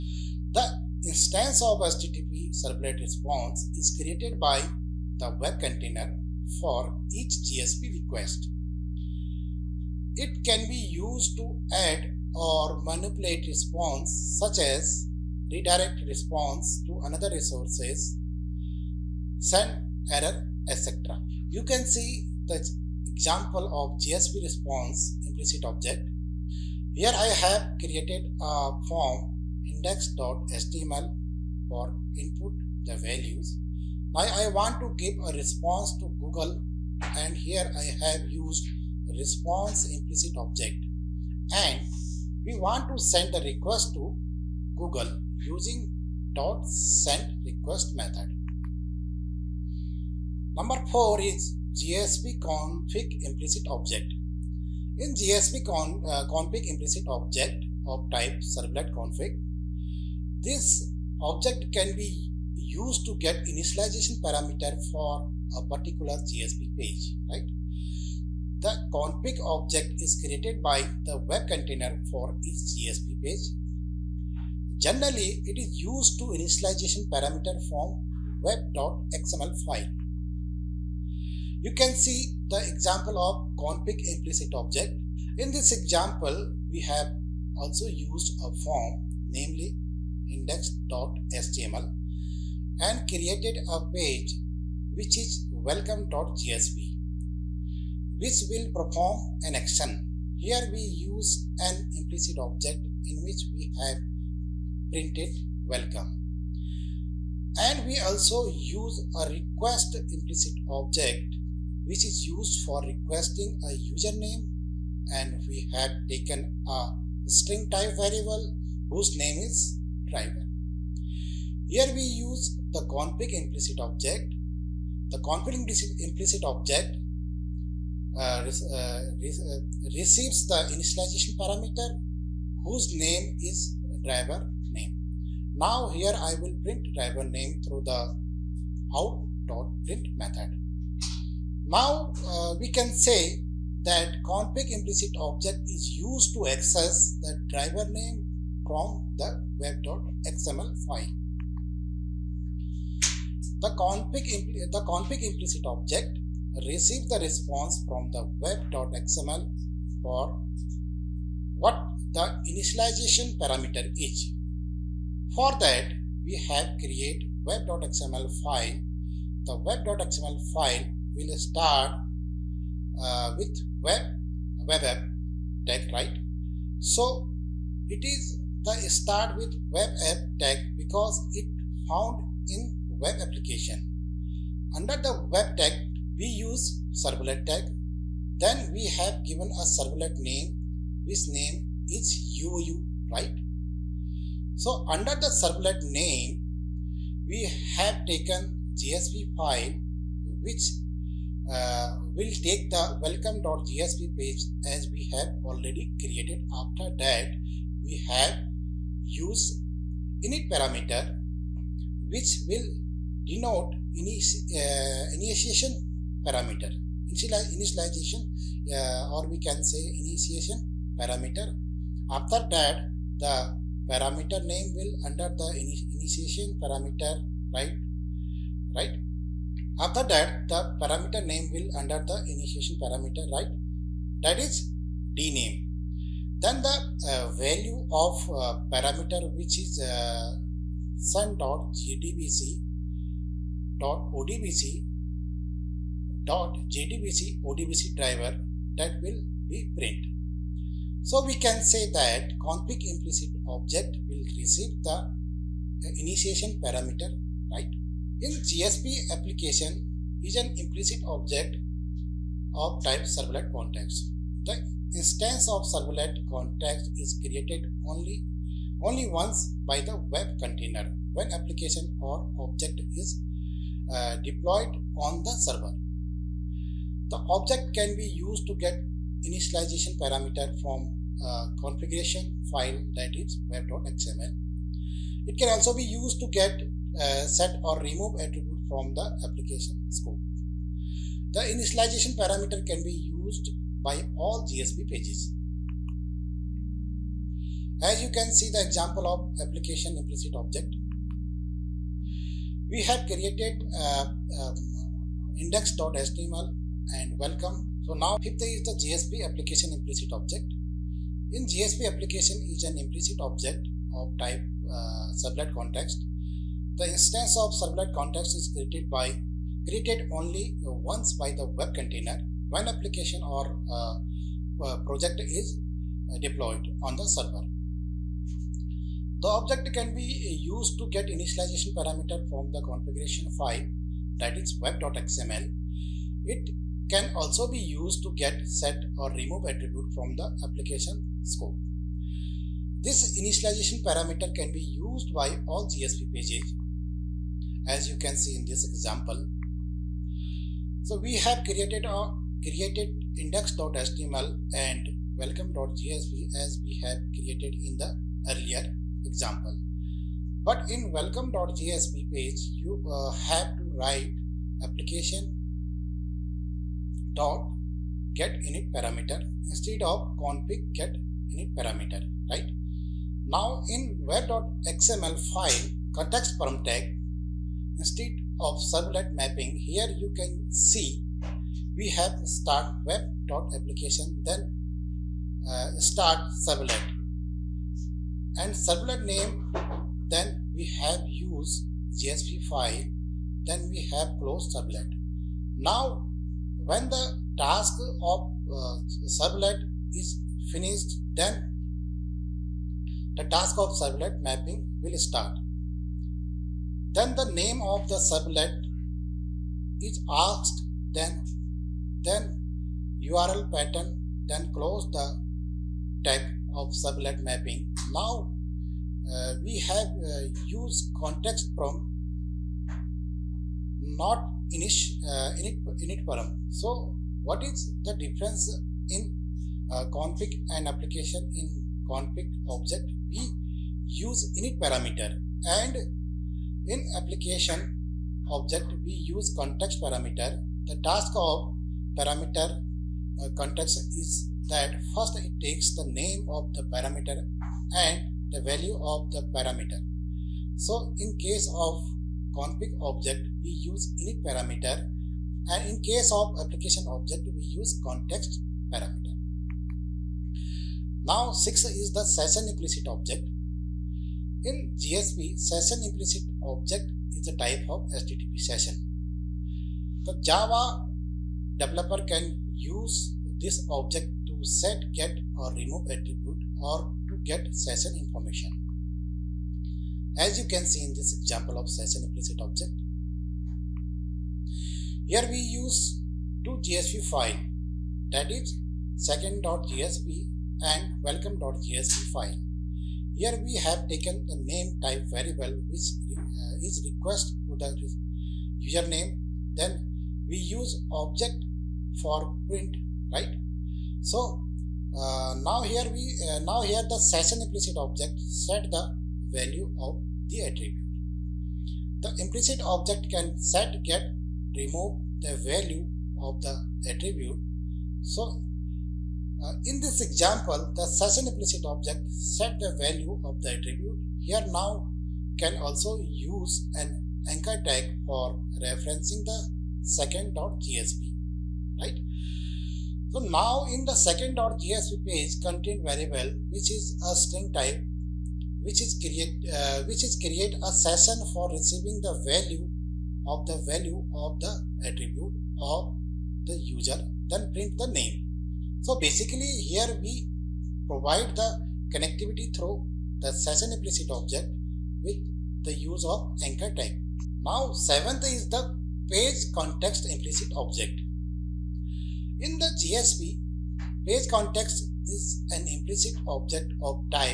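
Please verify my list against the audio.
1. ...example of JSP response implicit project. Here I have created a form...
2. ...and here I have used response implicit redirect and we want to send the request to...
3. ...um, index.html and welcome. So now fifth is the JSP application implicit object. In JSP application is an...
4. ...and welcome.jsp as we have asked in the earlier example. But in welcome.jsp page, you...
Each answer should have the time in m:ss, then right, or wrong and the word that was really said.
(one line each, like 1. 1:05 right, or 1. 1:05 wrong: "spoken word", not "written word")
1. 0:23 wrong: "object", not "project"
2. 0:37 wrong: "object", not "redirect"
3. 5:04 right
4. 5:54 wrong: "created", not "asked".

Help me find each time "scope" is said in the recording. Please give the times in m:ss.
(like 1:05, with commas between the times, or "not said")
4:49, 5:41.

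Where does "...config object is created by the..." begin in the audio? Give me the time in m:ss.
1:08.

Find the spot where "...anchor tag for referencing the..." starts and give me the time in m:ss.
8:47.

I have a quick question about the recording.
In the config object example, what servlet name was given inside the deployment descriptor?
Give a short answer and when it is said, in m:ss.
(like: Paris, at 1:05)
UU, at 3:12.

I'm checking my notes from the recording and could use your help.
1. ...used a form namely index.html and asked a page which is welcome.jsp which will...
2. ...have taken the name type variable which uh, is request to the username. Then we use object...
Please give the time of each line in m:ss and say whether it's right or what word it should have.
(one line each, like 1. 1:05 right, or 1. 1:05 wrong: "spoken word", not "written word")
1. 1:27 wrong: "created", not "asked"
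2. 8:13 right.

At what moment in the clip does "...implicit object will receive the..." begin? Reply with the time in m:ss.
4:12.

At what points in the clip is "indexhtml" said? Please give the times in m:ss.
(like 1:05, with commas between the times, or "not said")
0:29, 1:30, 5:05, 5:53.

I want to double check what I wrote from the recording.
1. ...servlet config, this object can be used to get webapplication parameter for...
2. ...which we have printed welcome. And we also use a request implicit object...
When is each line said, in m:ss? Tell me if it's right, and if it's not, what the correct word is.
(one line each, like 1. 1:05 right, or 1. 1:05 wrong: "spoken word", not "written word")
1. 0:58 wrong: "initialization", not "webapplication"
2. 1:43 right.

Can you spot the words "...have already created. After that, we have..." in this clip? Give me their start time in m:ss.
3:25.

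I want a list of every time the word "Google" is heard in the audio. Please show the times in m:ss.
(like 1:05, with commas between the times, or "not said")
0:36, 0:44.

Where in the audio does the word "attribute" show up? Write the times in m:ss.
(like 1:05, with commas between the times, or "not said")
4:48, 5:39, 7:55, 8:30, 8:36, 8:43, 9:04.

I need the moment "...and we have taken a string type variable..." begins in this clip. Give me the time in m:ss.
1:55.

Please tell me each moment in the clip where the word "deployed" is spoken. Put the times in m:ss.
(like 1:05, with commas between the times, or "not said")
4:34, 5:26.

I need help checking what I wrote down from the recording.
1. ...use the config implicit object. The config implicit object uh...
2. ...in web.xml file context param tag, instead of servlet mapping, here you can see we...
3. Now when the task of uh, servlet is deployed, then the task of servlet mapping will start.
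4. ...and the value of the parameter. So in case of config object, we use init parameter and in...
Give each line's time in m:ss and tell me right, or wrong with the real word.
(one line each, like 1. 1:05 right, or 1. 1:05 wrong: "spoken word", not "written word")
1. 2:02 right
2. 6:13 right
3. 6:35 wrong: "finished", not "deployed"
4. 7:27 right.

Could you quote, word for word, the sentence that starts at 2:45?
For that, we have create web.xml file.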